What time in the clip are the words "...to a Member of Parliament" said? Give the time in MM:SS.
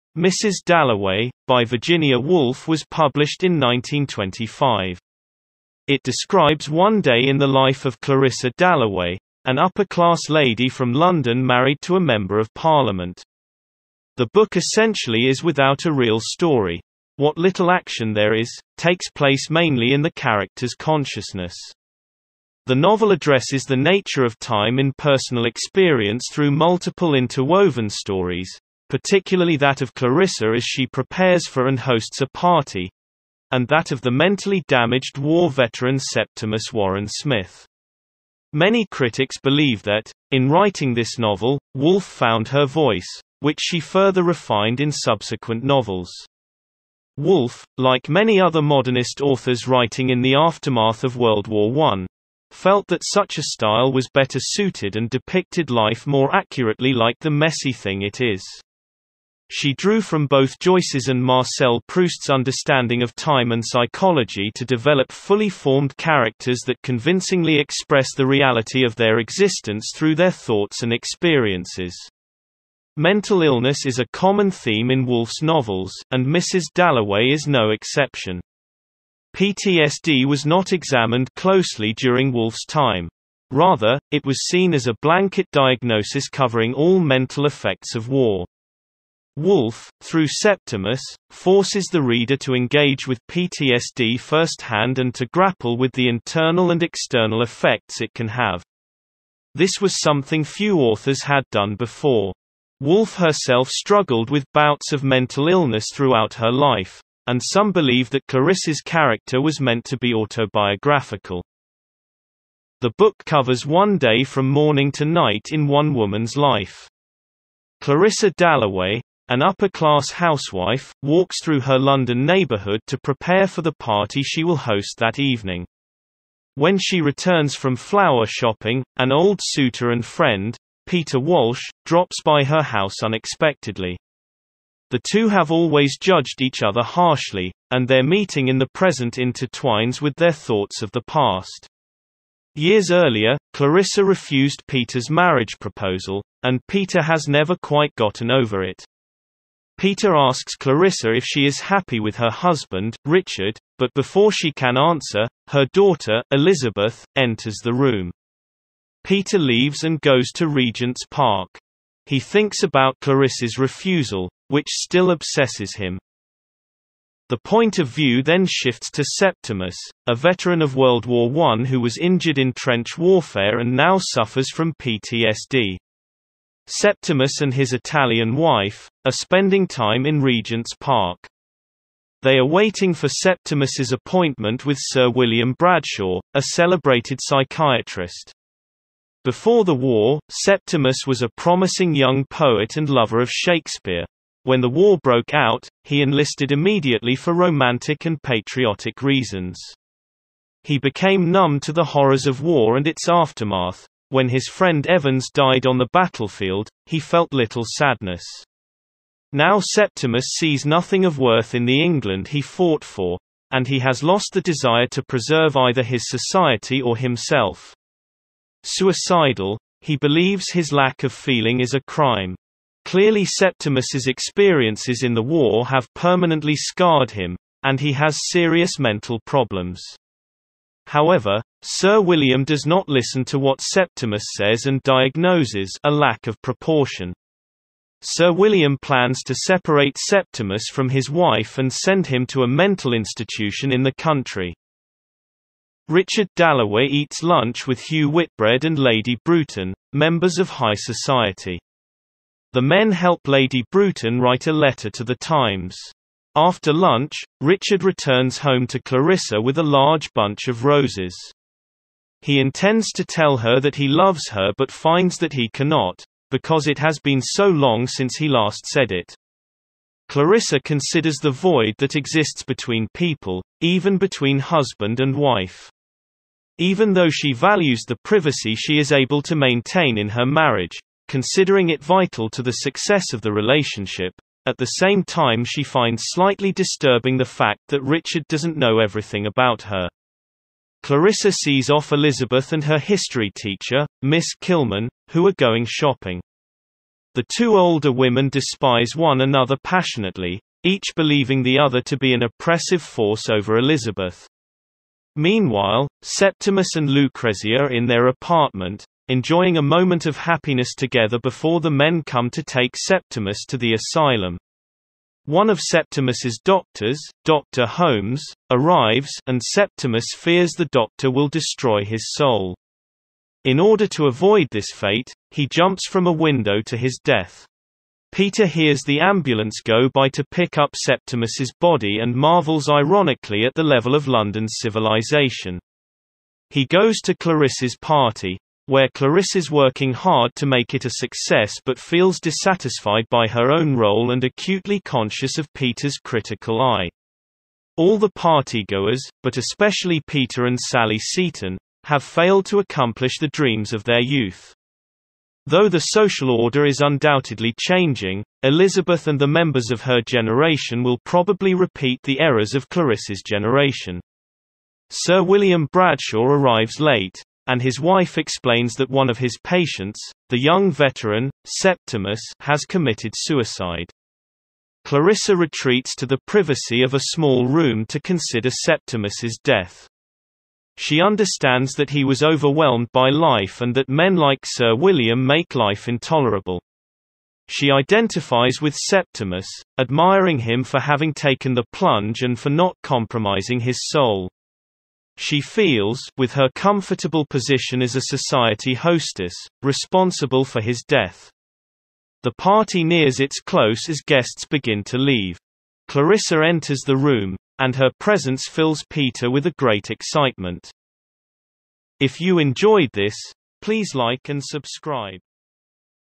00:11.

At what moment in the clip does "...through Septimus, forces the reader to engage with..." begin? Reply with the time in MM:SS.
01:30.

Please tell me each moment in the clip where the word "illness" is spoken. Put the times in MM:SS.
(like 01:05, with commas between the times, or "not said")
01:13, 01:45.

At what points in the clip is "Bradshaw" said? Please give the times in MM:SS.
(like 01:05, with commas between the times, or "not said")
03:05, 06:05.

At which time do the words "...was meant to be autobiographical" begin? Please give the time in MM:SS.
01:49.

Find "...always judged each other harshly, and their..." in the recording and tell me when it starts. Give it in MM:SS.
02:15.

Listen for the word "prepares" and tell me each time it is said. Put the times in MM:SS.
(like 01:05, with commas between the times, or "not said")
00:30, 02:02.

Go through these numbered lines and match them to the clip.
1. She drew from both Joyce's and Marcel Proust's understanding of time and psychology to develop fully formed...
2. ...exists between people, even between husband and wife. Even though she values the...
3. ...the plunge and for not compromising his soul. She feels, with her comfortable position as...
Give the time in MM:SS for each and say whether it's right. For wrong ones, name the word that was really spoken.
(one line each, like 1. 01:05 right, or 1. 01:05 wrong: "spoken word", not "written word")
1. 00:59 right
2. 04:31 right
3. 06:31 right.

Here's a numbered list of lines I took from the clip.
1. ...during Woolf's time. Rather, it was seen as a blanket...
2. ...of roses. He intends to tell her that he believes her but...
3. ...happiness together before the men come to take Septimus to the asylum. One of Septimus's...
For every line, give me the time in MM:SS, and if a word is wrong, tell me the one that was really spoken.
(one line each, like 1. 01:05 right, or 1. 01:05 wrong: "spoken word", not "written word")
1. 01:21 right
2. 04:20 wrong: "loves", not "believes"
3. 05:10 right.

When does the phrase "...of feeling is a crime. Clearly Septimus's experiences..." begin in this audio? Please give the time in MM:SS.
03:41.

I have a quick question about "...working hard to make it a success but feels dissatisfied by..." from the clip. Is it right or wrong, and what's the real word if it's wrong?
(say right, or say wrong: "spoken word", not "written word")
right.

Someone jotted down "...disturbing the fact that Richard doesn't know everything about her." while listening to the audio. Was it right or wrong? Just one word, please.
right.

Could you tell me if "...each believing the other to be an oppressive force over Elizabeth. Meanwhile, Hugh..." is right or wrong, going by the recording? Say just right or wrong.
wrong.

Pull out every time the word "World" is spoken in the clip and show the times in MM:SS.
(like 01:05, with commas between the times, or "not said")
00:51, 02:50.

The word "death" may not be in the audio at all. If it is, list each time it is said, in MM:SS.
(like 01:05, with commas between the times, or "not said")
05:27, 06:19, 06:40.